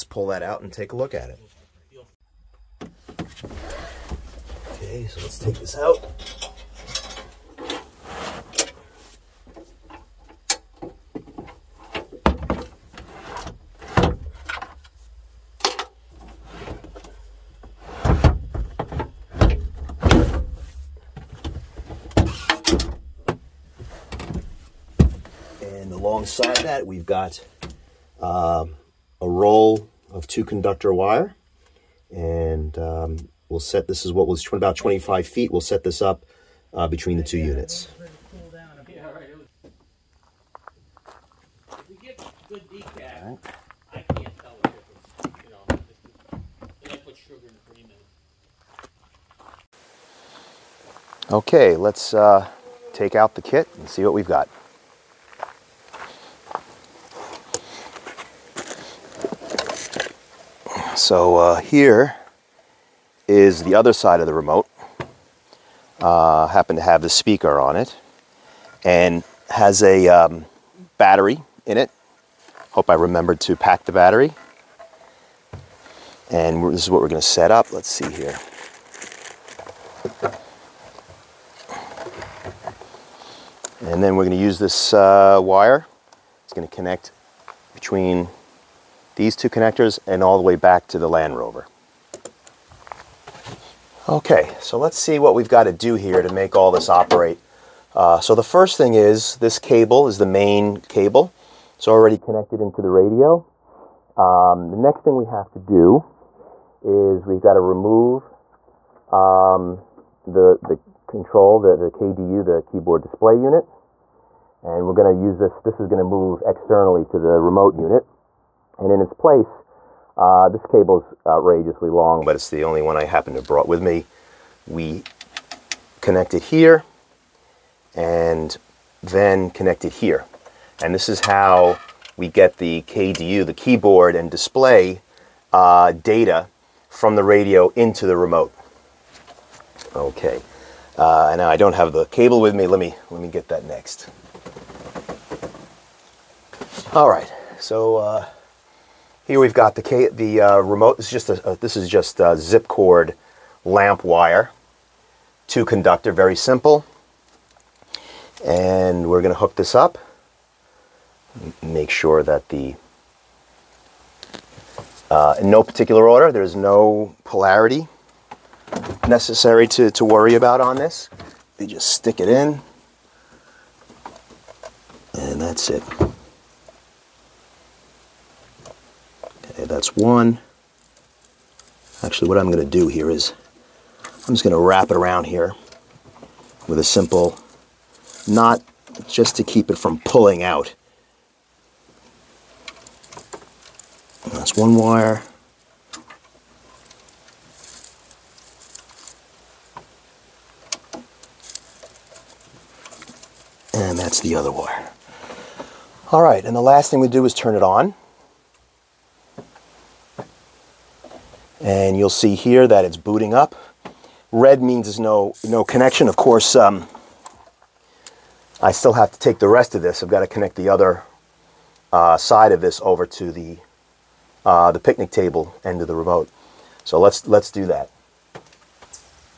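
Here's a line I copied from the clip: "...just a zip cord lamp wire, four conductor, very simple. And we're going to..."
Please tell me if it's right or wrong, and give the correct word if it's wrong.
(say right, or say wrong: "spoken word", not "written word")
wrong: "two", not "four".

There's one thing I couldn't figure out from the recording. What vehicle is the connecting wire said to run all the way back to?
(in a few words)
Land Rover.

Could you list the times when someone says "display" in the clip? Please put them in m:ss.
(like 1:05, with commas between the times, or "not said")
1:53, 2:14.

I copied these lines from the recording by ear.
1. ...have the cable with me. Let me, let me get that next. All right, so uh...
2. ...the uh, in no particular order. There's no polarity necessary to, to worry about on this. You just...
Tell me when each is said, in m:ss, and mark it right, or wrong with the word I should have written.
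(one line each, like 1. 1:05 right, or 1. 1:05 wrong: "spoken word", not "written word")
1. 2:21 right
2. 2:42 right.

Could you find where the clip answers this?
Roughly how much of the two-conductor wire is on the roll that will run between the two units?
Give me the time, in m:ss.
0:34.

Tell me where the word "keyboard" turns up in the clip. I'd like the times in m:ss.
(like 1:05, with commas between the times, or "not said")
1:52, 2:13.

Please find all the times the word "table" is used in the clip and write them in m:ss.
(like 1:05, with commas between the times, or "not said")
3:45.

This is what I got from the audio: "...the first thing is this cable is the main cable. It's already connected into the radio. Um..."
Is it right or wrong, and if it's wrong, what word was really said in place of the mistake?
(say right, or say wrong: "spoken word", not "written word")
right.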